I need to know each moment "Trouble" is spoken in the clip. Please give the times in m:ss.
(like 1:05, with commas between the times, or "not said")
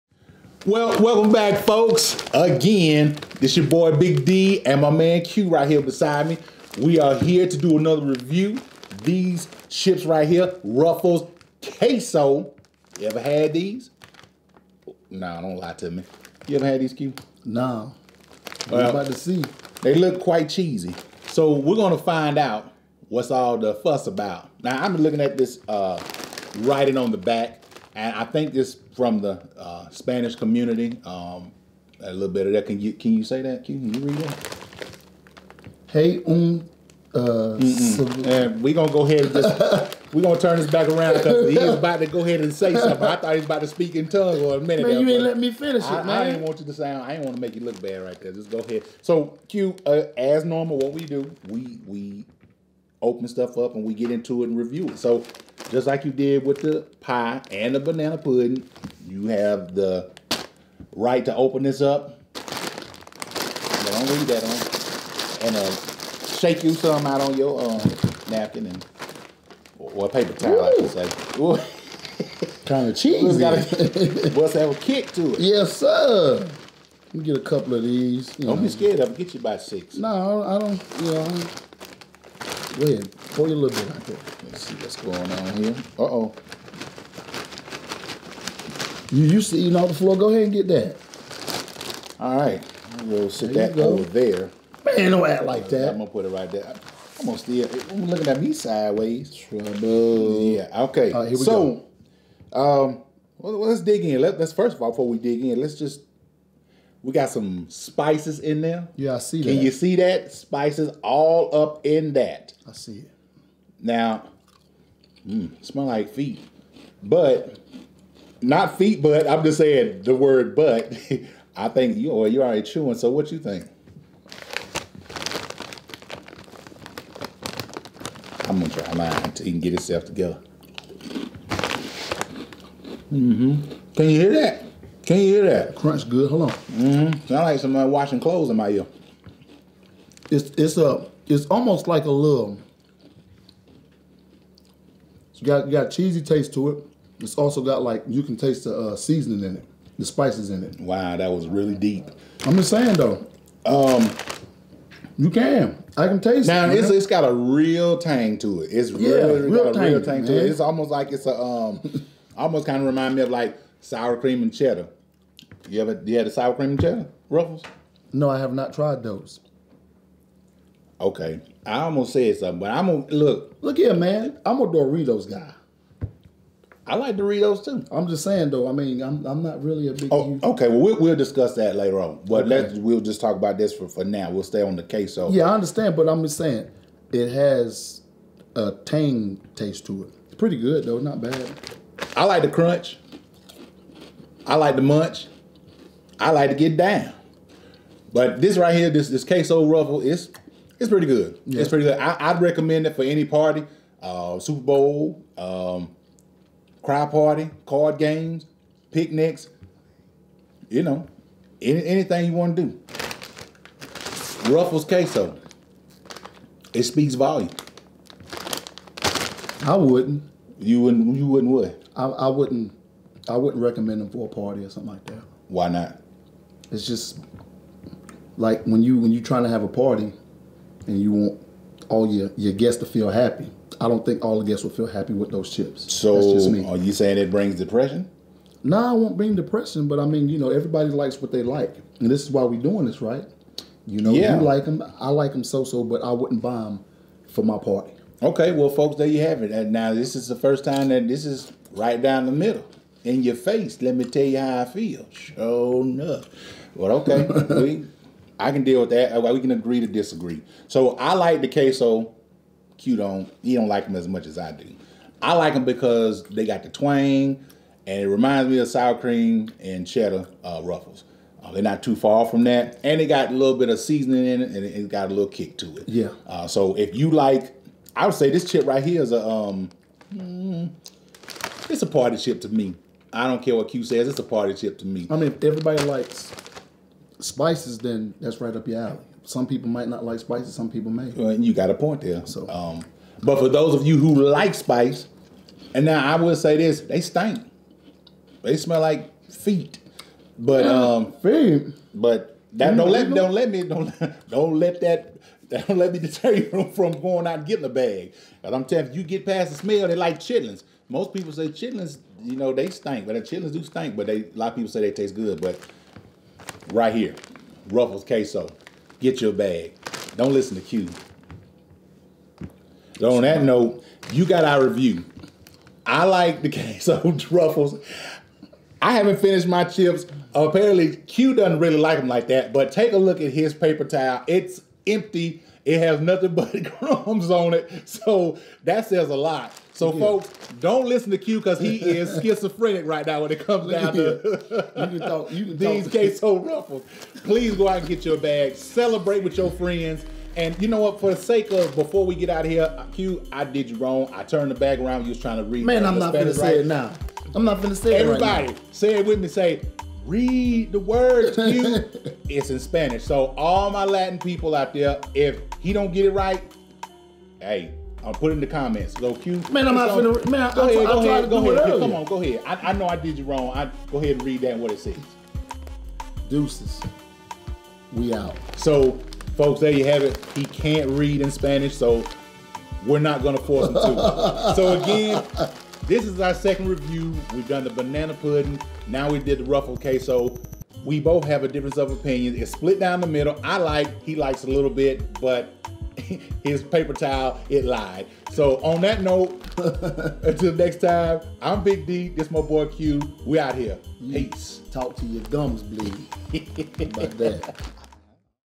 1:39.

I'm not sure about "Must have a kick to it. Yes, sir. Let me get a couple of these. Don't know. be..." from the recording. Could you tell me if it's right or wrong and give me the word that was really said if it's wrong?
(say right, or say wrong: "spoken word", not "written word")
right.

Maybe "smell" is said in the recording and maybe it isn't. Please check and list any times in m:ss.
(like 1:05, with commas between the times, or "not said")
1:55, 4:58, 5:09.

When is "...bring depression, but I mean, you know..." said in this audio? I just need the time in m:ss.
3:59.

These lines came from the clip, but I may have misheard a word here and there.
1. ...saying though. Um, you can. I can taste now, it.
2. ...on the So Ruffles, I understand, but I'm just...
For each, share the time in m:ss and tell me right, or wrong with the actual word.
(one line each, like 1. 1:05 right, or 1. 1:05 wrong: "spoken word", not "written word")
1. 2:32 right
2. 3:04 wrong: "Yeah", not "Ruffles".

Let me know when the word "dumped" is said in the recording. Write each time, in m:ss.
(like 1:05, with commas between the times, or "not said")
not said.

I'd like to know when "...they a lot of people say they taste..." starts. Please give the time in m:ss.
5:14.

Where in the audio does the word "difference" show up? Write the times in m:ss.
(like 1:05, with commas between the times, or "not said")
6:31.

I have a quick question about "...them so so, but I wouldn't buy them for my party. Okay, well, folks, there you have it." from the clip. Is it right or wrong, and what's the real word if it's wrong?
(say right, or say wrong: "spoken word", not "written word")
right.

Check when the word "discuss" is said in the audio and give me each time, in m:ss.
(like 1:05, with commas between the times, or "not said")
3:01.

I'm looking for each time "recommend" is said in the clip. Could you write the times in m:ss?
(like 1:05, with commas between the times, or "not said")
3:22, 3:43.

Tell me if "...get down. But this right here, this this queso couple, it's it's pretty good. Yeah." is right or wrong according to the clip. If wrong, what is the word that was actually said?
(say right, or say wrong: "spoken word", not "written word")
wrong: "ruffle", not "couple".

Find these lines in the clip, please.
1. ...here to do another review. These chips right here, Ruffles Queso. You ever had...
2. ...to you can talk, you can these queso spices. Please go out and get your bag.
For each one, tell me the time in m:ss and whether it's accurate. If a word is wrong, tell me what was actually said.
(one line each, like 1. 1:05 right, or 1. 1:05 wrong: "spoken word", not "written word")
1. 0:07 right
2. 5:43 wrong: "ruffles", not "spices".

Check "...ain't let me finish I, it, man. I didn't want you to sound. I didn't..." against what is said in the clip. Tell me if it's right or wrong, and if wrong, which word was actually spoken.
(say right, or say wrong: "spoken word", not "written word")
right.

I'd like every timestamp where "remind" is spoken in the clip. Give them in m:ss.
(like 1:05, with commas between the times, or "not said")
2:42, 4:28.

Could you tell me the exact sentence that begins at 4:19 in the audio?
Uh, we can agree to disagree.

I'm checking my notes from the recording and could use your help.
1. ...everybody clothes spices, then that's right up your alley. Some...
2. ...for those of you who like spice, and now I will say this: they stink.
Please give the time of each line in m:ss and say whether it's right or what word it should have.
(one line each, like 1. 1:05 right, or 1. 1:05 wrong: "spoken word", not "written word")
1. 4:45 wrong: "likes", not "clothes"
2. 4:53 right.